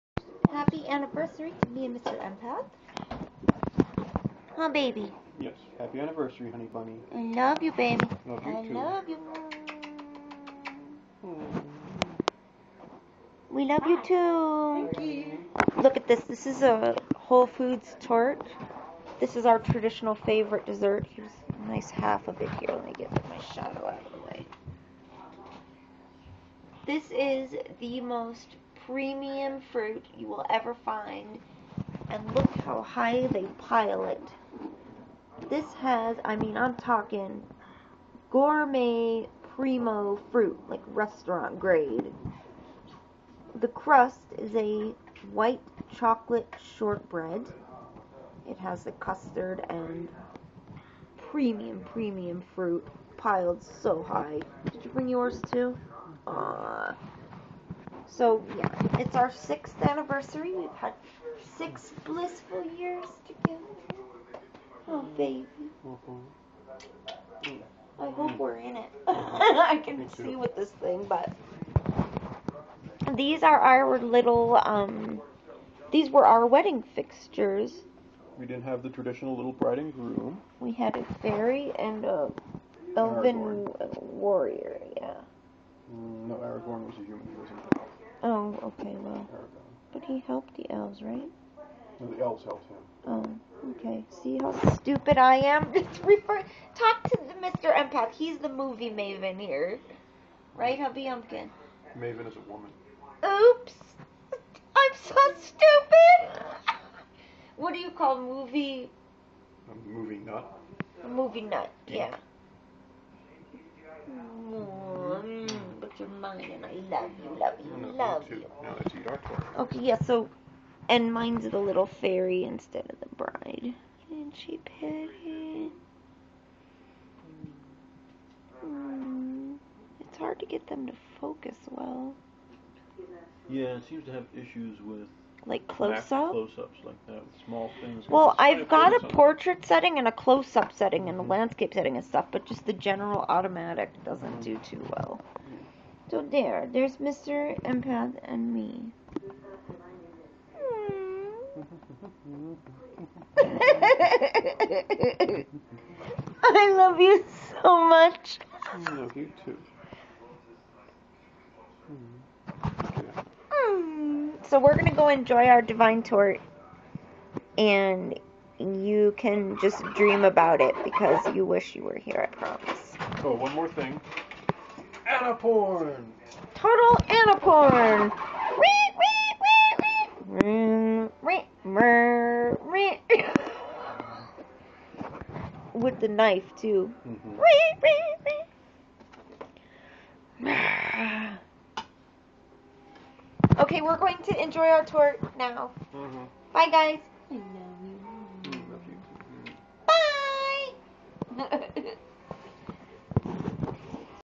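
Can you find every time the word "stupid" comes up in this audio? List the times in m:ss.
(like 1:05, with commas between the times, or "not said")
1:34, 1:45.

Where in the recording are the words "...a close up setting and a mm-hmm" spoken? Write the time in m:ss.
2:20.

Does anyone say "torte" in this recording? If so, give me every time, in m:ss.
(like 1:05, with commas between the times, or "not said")
2:46, 3:14.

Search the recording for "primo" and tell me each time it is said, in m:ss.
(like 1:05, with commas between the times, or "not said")
0:39.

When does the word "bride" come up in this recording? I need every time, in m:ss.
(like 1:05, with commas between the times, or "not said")
1:19, 2:03.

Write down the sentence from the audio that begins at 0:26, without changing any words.
This is the most premium fruit you will ever find, and look how high they pile it.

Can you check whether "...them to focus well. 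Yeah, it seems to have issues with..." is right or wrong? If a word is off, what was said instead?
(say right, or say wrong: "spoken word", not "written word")
right.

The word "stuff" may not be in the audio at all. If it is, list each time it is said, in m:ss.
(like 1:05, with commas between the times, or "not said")
2:22.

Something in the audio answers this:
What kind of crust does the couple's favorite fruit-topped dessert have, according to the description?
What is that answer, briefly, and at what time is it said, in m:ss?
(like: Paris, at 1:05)
White chocolate shortbread, at 0:45.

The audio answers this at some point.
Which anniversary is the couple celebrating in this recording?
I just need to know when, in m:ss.
0:59.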